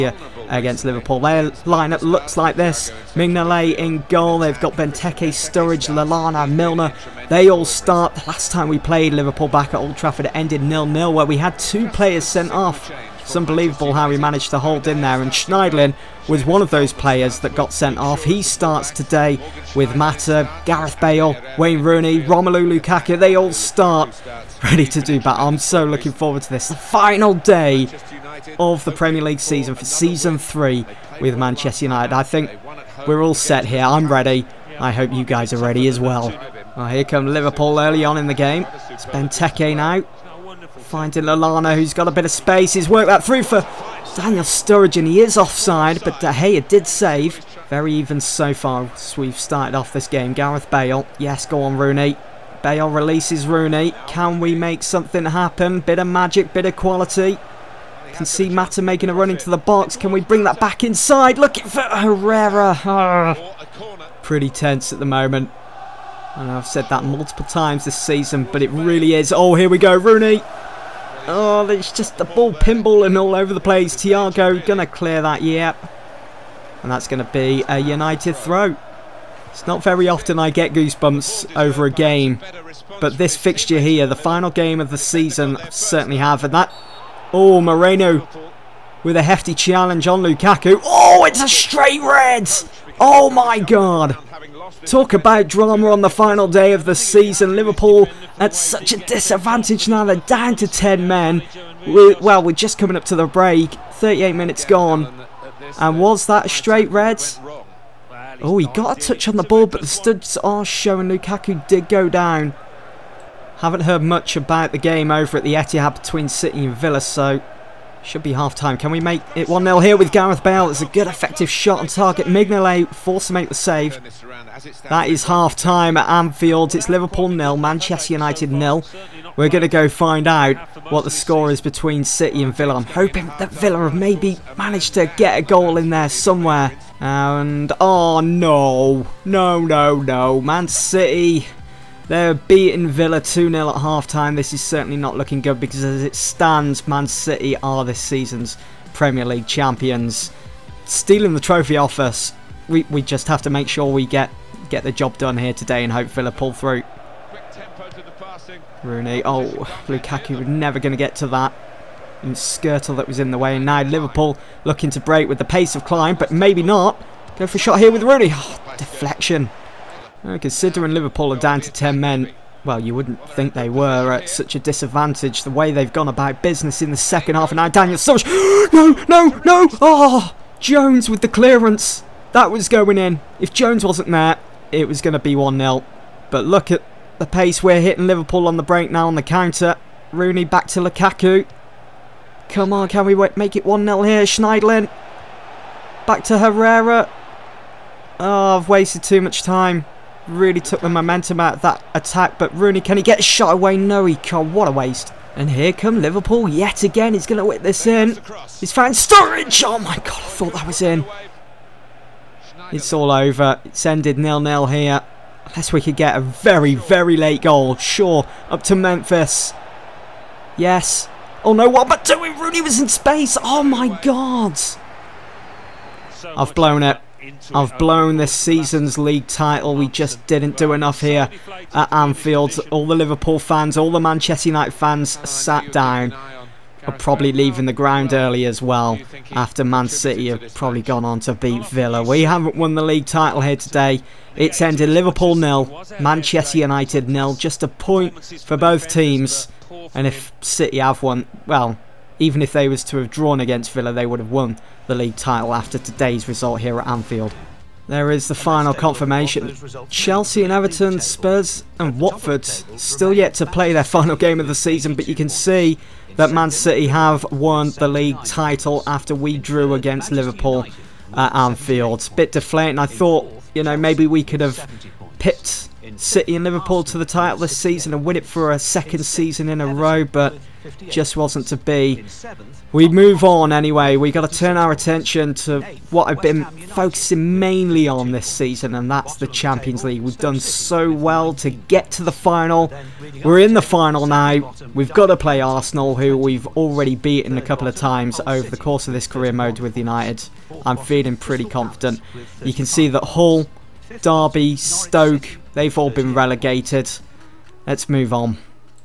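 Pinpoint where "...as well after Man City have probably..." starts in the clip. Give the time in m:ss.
3:58.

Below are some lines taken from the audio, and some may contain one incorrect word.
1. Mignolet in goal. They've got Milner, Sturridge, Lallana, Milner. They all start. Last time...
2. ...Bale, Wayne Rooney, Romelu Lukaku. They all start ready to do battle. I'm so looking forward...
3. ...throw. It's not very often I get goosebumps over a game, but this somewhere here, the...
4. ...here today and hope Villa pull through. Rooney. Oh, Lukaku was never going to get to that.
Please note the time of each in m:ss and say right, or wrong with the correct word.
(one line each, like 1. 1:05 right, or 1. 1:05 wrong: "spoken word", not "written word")
1. 0:03 wrong: "Benteke", not "Milner"
2. 0:20 right
3. 1:18 wrong: "fixture", not "somewhere"
4. 2:35 right.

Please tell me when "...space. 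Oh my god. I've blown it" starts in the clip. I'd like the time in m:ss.
3:42.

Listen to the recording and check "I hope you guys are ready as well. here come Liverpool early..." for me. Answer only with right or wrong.
right.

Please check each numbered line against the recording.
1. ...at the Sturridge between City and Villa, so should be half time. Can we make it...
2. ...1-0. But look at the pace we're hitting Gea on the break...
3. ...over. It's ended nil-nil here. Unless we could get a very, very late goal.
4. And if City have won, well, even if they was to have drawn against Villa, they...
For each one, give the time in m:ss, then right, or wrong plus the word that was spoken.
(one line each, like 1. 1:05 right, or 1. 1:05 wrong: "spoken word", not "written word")
1. 1:55 wrong: "Etihad", not "Sturridge"
2. 3:05 wrong: "Liverpool", not "Gea"
3. 3:33 right
4. 4:09 right.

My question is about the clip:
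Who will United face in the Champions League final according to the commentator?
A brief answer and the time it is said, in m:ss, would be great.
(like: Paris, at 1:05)
Arsenal, at 4:55.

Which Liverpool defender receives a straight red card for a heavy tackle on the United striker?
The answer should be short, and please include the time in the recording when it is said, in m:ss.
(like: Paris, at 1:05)
Moreno, at 1:27.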